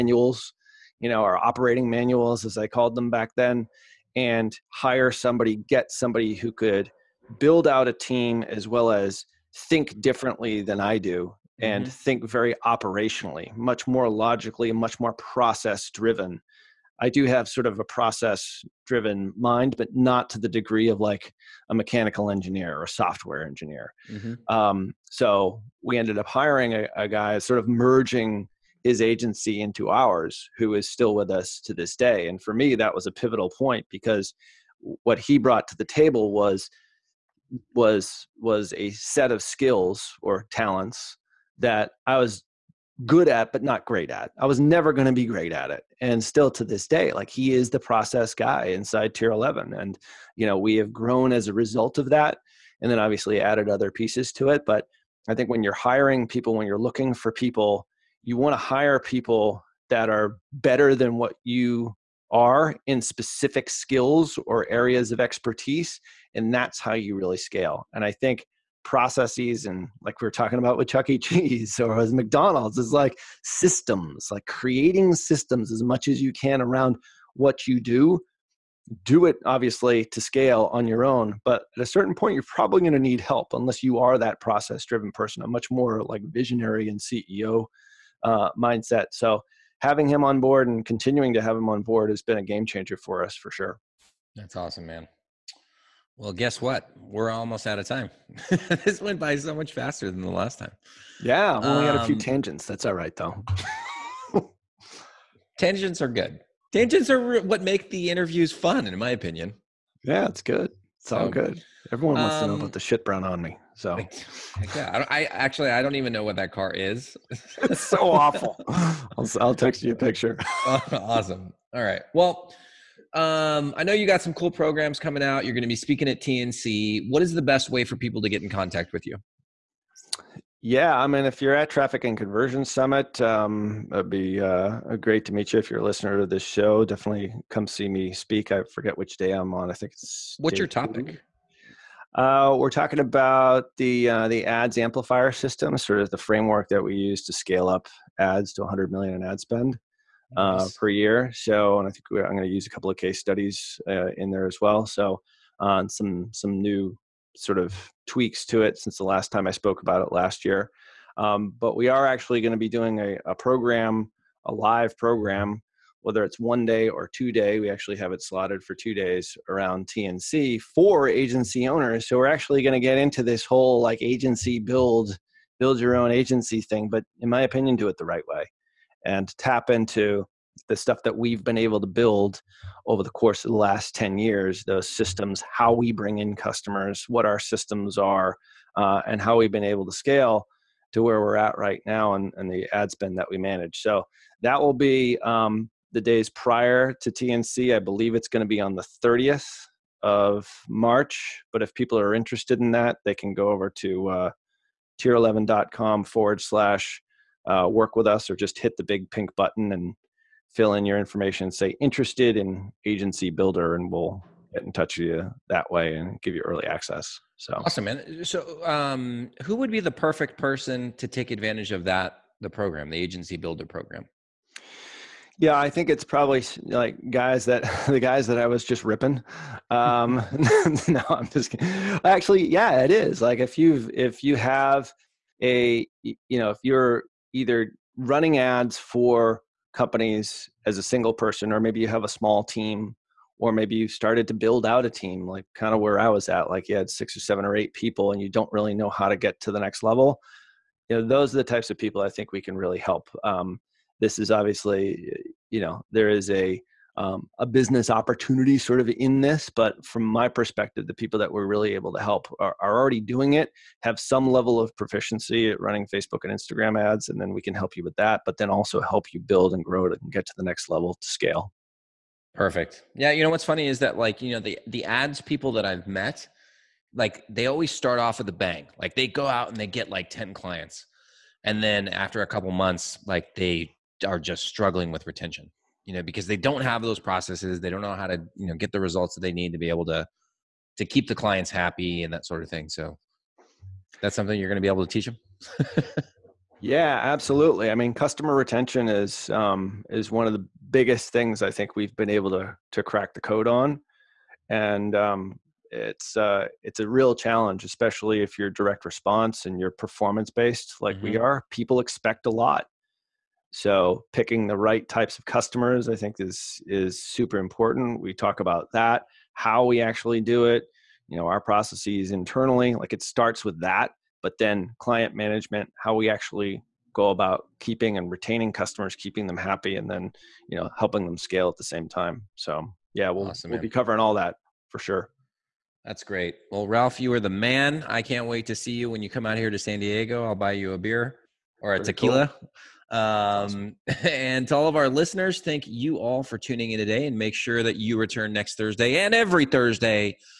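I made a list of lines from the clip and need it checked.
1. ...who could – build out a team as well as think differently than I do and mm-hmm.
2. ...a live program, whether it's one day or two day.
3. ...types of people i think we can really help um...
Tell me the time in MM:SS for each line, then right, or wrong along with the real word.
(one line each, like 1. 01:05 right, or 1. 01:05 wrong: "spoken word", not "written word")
1. 00:06 right
2. 02:44 right
3. 04:11 right.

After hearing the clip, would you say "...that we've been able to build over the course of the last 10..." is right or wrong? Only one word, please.
right.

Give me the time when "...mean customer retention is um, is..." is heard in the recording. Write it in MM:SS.
04:57.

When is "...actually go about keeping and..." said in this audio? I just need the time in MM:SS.
05:26.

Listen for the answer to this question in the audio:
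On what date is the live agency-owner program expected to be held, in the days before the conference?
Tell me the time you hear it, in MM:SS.
03:19.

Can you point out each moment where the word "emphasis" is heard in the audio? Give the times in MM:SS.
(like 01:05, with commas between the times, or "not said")
not said.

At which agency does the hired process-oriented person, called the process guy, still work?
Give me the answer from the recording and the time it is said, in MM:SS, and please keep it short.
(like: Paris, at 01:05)
Tier 11, at 00:49.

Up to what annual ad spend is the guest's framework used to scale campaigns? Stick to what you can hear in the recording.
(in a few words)
100 million.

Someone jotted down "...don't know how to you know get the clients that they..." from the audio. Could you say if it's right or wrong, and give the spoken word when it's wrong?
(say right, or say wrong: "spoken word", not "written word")
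wrong: "results", not "clients".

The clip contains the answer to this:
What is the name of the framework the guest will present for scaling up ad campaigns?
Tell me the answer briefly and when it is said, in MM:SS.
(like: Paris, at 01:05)
ads amplifier system, at 02:24.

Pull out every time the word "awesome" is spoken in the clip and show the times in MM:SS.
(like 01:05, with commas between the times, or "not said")
01:34, 02:00, 03:37, 05:33.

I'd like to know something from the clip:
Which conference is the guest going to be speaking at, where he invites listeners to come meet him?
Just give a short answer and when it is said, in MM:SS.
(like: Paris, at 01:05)
Traffic and Conversion Summit, at 02:11.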